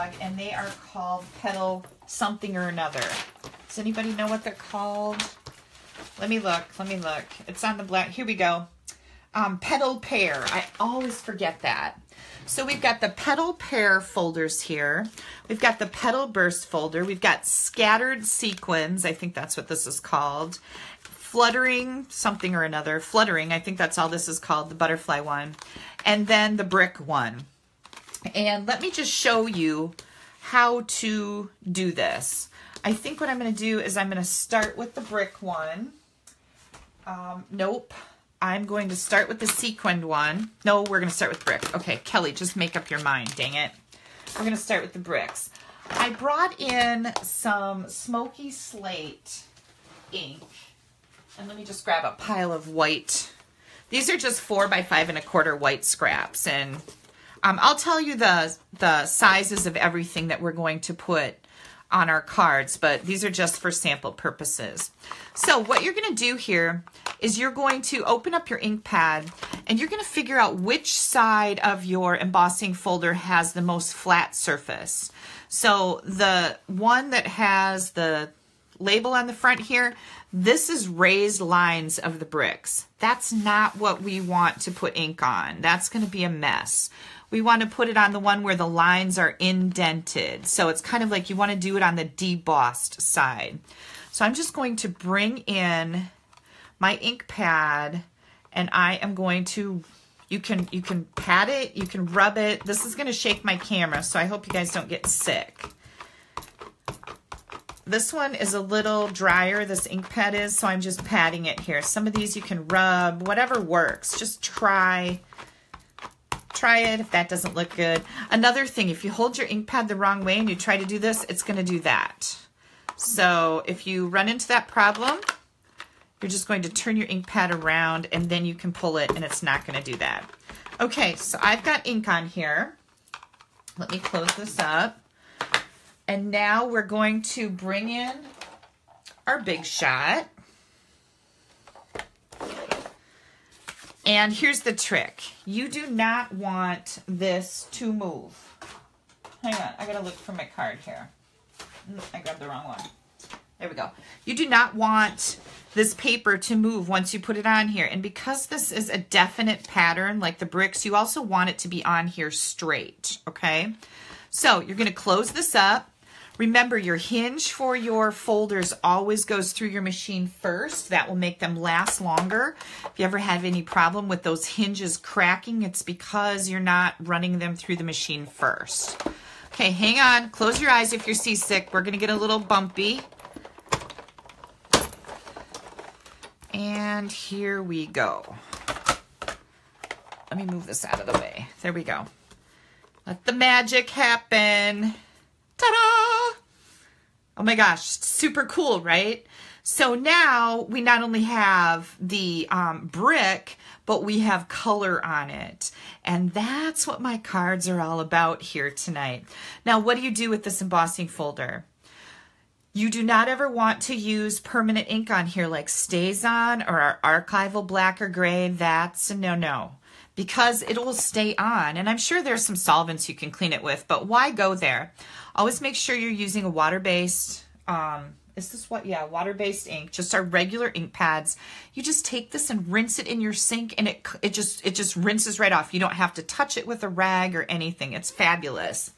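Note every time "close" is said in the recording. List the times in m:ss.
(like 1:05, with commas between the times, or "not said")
2:13, 2:44, 3:00.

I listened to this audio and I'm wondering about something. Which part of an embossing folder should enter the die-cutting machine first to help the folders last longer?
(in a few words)
hinge.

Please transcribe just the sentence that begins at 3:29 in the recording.
Now, what do you do with this embossing folder?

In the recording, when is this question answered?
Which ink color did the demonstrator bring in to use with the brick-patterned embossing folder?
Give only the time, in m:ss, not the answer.
0:47.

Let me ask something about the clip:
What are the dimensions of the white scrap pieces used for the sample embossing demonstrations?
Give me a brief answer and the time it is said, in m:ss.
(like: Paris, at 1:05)
4 by 5 1/4, at 0:54.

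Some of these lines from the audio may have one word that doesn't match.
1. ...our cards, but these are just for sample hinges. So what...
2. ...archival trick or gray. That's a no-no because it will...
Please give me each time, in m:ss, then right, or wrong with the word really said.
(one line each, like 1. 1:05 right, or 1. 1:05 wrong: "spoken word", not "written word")
1. 1:02 wrong: "purposes", not "hinges"
2. 3:37 wrong: "black", not "trick".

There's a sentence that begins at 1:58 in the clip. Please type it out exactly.
Another thing, if you hold your ink pad the wrong way and you try to do this, it's going to do that.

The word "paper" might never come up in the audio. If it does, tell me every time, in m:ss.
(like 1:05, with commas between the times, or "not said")
2:35.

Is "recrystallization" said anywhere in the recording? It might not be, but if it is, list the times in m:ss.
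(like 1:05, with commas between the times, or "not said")
not said.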